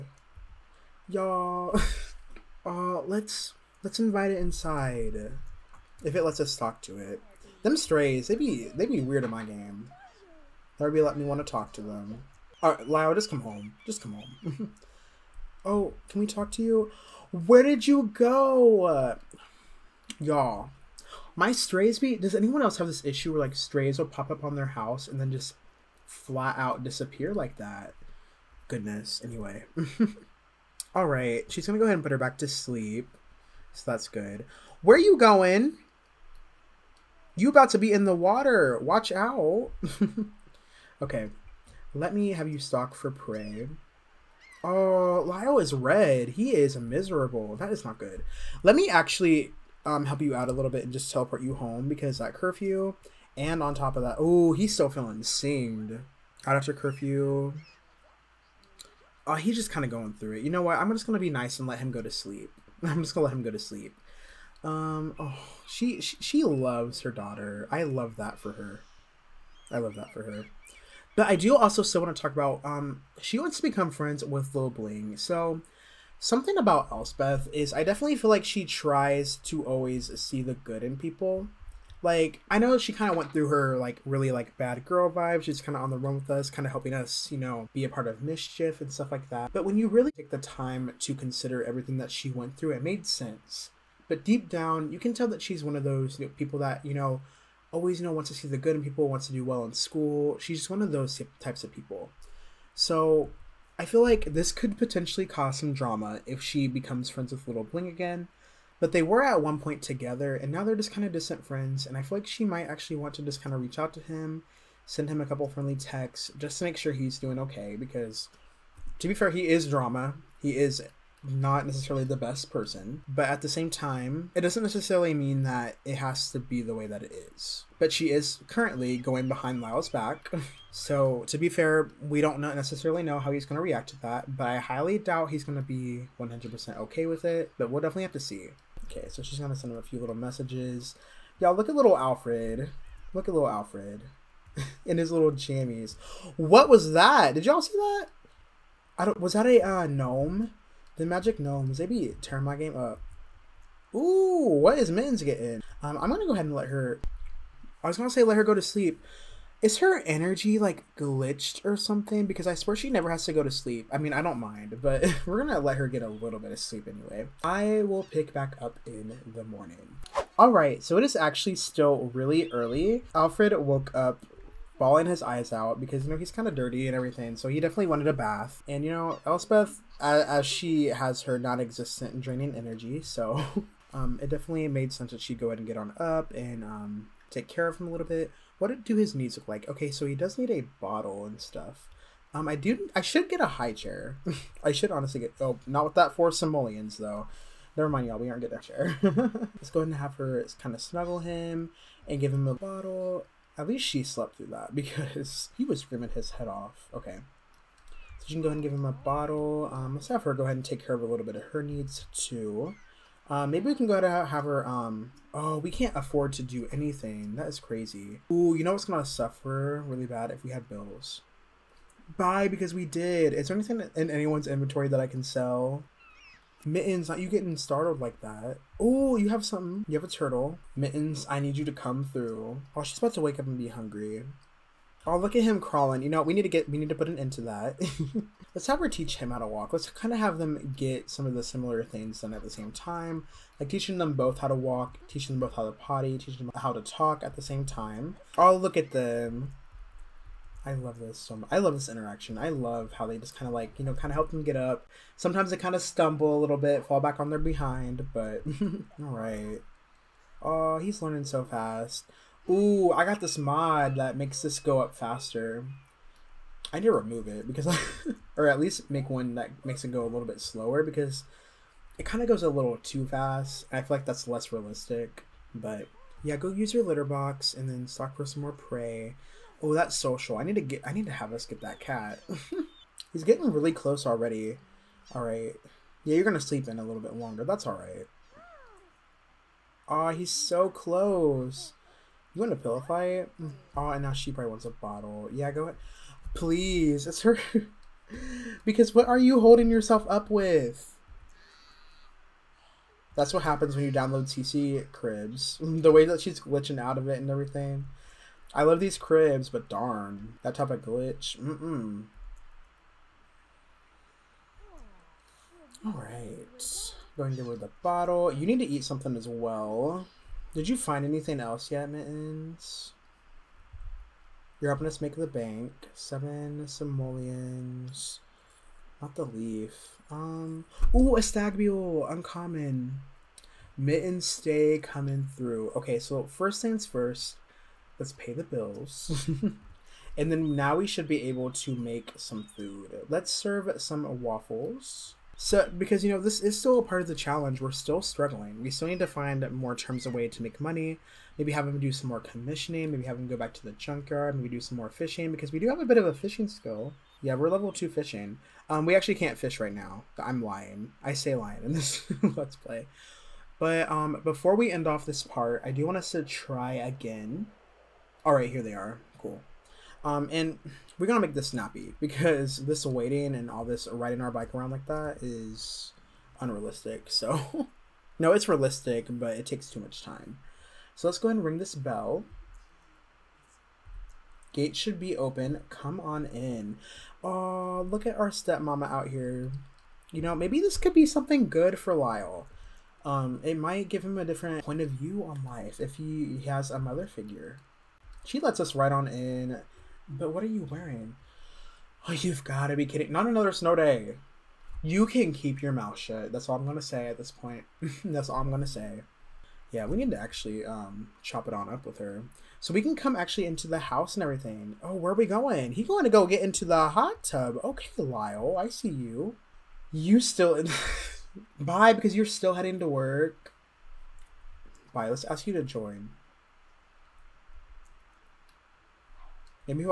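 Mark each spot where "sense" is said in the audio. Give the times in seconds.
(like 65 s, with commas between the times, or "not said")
93 s, 184 s.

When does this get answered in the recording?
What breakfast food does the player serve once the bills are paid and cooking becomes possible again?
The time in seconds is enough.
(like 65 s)
344 s.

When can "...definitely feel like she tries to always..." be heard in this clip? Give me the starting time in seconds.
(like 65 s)
77 s.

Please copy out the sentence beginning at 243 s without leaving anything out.
Like teaching them both how to walk, teaching them both how to potty, teaching them how to talk at the same time.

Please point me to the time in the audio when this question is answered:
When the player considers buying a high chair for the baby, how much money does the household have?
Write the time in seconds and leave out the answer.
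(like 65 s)
196 s.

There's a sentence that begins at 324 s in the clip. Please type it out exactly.
You're helping us make the bank.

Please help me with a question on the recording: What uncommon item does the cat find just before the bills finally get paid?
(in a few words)
stag mule.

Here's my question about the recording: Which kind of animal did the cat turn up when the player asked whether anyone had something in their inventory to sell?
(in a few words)
turtle.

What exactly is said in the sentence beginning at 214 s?
Um, oh, we can't afford to do anything.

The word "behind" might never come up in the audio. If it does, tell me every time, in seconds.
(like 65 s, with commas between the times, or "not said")
129 s, 257 s.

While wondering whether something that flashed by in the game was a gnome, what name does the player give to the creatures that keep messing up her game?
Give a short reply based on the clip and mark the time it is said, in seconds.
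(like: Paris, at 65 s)
Magic Gnomes, at 150 s.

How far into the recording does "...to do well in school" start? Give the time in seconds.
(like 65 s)
99 s.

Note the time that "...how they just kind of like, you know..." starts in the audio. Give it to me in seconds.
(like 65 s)
252 s.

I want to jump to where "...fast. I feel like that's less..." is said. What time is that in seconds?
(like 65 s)
273 s.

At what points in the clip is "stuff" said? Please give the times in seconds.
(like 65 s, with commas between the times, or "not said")
88 s, 191 s.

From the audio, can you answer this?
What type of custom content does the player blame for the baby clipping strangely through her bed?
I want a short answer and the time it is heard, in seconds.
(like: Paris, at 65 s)
CC cribs, at 304 s.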